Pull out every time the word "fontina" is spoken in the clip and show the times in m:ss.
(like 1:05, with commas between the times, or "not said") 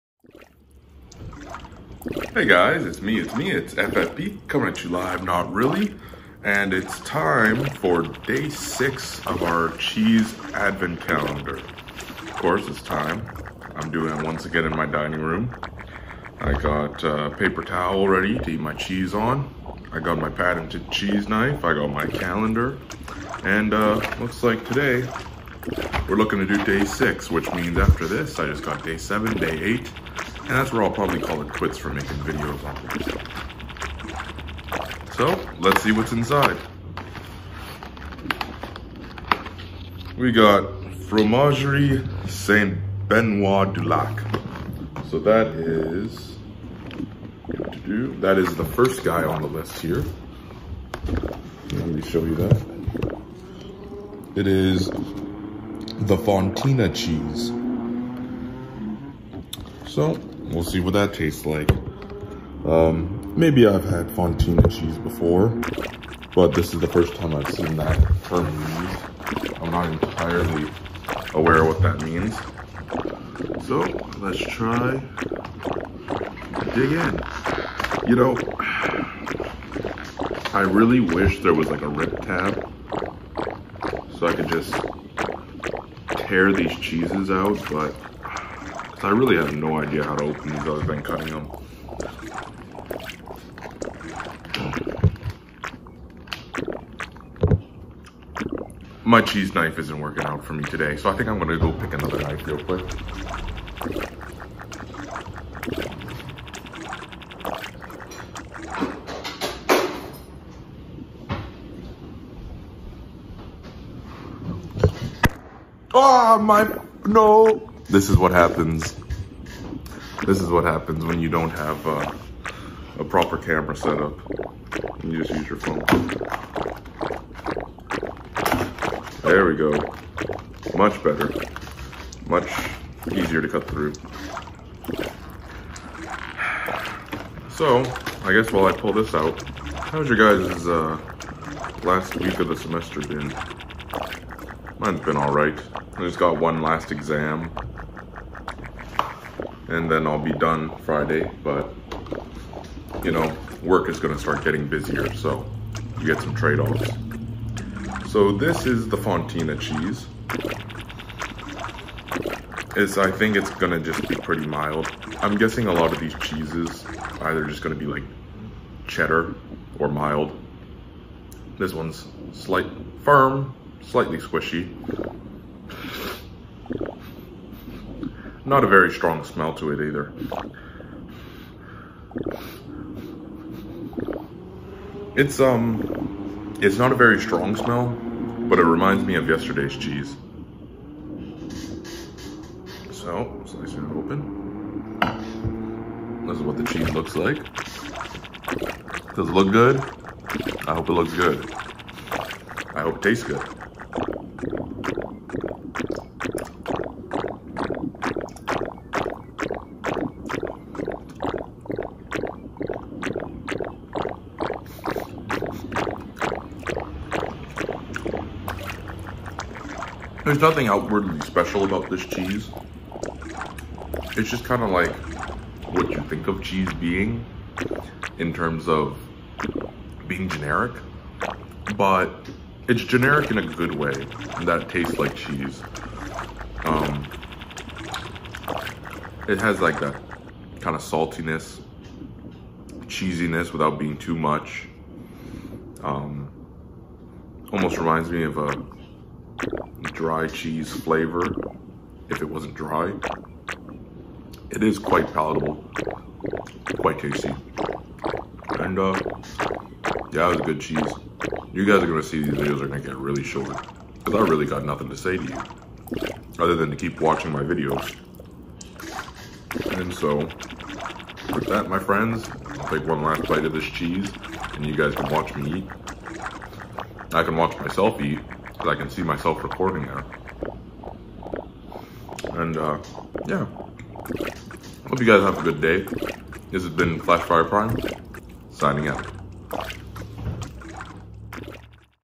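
0:56, 1:04, 2:38.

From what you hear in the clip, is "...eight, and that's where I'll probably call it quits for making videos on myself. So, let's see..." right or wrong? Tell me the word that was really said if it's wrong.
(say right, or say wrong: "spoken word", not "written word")
right.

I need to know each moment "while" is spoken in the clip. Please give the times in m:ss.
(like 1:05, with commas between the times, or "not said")
2:18.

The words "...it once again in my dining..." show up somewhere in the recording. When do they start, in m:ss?
0:14.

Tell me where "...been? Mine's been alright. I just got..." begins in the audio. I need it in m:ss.
2:23.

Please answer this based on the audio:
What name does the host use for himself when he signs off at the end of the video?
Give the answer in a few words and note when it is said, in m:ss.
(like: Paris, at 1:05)
Flashfire Prime, at 4:46.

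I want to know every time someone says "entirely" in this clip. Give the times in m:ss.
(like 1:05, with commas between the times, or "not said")
1:09.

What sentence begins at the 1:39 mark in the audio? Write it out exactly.
My cheese knife isn't working out for me today, so I think I'm gonna go pick another knife real quick.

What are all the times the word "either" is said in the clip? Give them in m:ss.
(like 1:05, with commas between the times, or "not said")
2:47, 2:59.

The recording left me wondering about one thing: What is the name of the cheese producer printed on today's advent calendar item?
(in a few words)
Fromagerie Saint Benoit du Lac.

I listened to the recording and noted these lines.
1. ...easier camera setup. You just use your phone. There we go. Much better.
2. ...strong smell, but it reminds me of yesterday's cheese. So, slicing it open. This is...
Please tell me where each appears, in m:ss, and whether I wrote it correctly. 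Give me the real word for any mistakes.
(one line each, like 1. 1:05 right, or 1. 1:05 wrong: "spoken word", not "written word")
1. 2:03 wrong: "proper", not "easier"
2. 3:07 right.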